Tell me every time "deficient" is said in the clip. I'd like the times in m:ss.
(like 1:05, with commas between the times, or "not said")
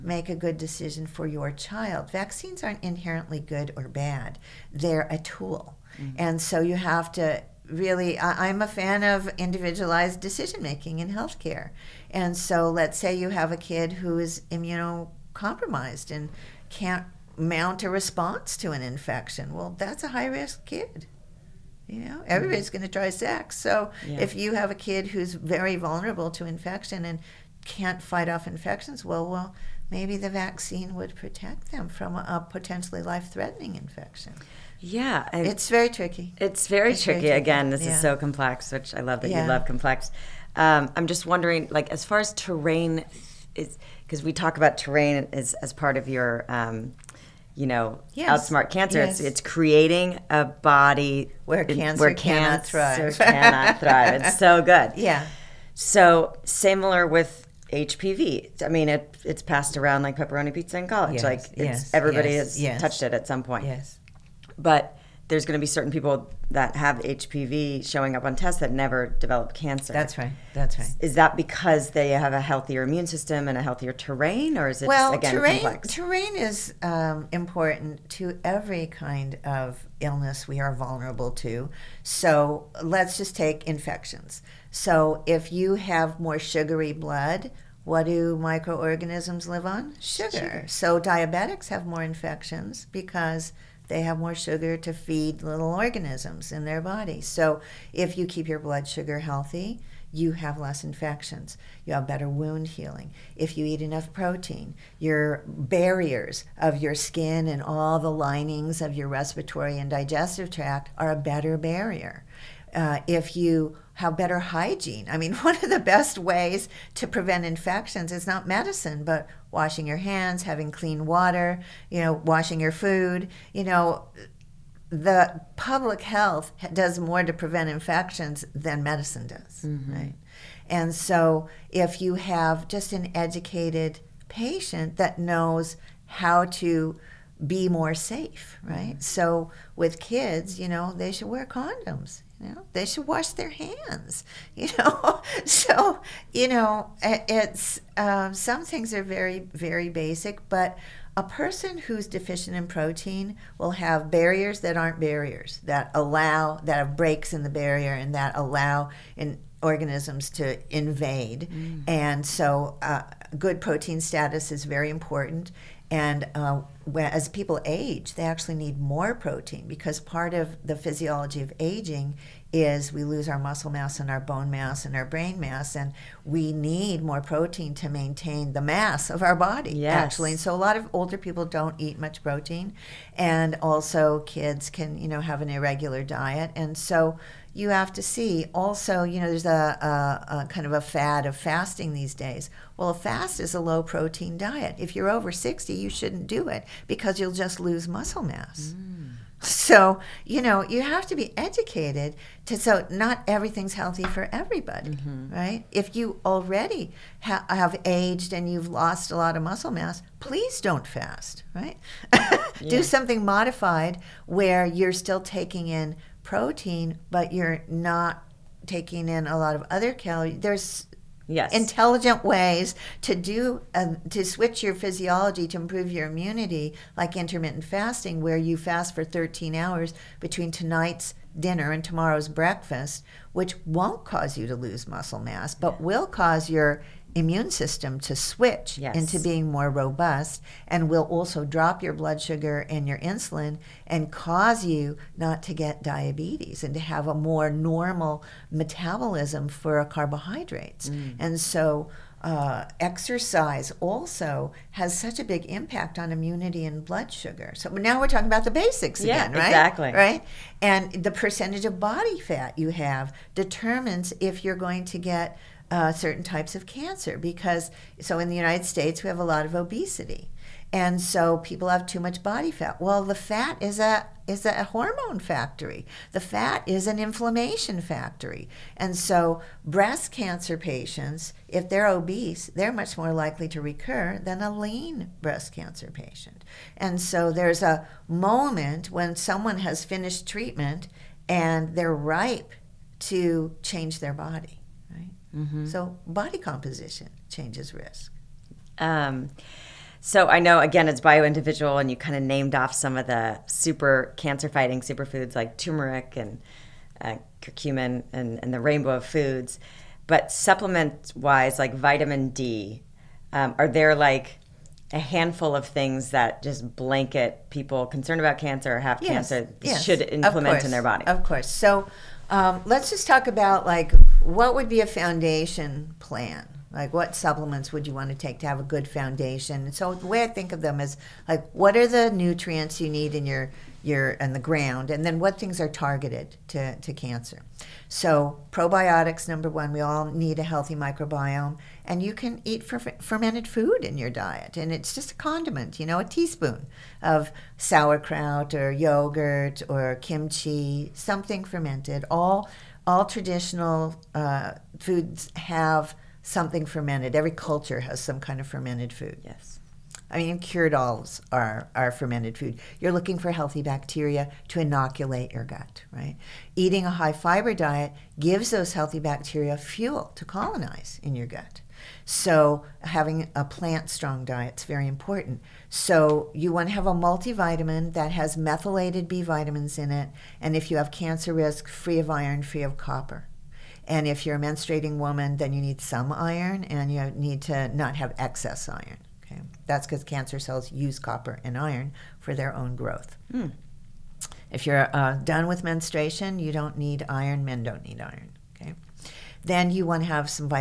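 2:32.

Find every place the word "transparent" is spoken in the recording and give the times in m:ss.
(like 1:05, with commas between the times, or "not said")
not said.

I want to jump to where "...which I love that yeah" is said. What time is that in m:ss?
0:38.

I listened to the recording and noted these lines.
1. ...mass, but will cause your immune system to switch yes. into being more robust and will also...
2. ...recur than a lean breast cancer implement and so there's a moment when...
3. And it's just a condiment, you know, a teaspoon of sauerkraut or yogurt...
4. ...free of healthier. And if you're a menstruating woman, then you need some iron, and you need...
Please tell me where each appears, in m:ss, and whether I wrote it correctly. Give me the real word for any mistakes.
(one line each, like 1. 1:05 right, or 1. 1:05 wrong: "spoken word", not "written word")
1. 3:55 right
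2. 4:43 wrong: "patient", not "implement"
3. 5:44 right
4. 6:22 wrong: "copper", not "healthier".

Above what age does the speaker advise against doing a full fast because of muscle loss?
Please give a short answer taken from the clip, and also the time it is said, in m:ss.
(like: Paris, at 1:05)
60, at 3:15.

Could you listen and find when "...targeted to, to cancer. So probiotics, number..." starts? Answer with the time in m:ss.
5:35.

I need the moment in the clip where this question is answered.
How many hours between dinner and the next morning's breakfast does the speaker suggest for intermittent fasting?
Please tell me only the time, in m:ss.
3:49.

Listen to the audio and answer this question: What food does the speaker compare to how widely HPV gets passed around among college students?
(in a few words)
pepperoni pizza.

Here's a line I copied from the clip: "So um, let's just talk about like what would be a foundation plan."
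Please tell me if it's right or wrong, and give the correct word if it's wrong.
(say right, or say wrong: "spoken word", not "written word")
right.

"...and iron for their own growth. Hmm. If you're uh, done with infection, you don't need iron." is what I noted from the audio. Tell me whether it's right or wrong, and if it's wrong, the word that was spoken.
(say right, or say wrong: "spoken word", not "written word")
wrong: "menstruation", not "infection".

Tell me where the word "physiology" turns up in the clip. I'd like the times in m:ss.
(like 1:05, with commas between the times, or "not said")
2:50, 3:44.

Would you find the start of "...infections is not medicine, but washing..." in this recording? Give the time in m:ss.
1:57.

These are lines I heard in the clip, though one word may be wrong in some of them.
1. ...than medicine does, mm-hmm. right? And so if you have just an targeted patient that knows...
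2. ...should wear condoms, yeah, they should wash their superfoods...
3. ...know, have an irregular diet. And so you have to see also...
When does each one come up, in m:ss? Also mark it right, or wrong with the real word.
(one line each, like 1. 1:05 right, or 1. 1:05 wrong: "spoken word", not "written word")
1. 2:08 wrong: "educated", not "targeted"
2. 2:21 wrong: "hands", not "superfoods"
3. 3:05 right.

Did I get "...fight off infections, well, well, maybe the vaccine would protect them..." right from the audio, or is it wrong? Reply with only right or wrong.
right.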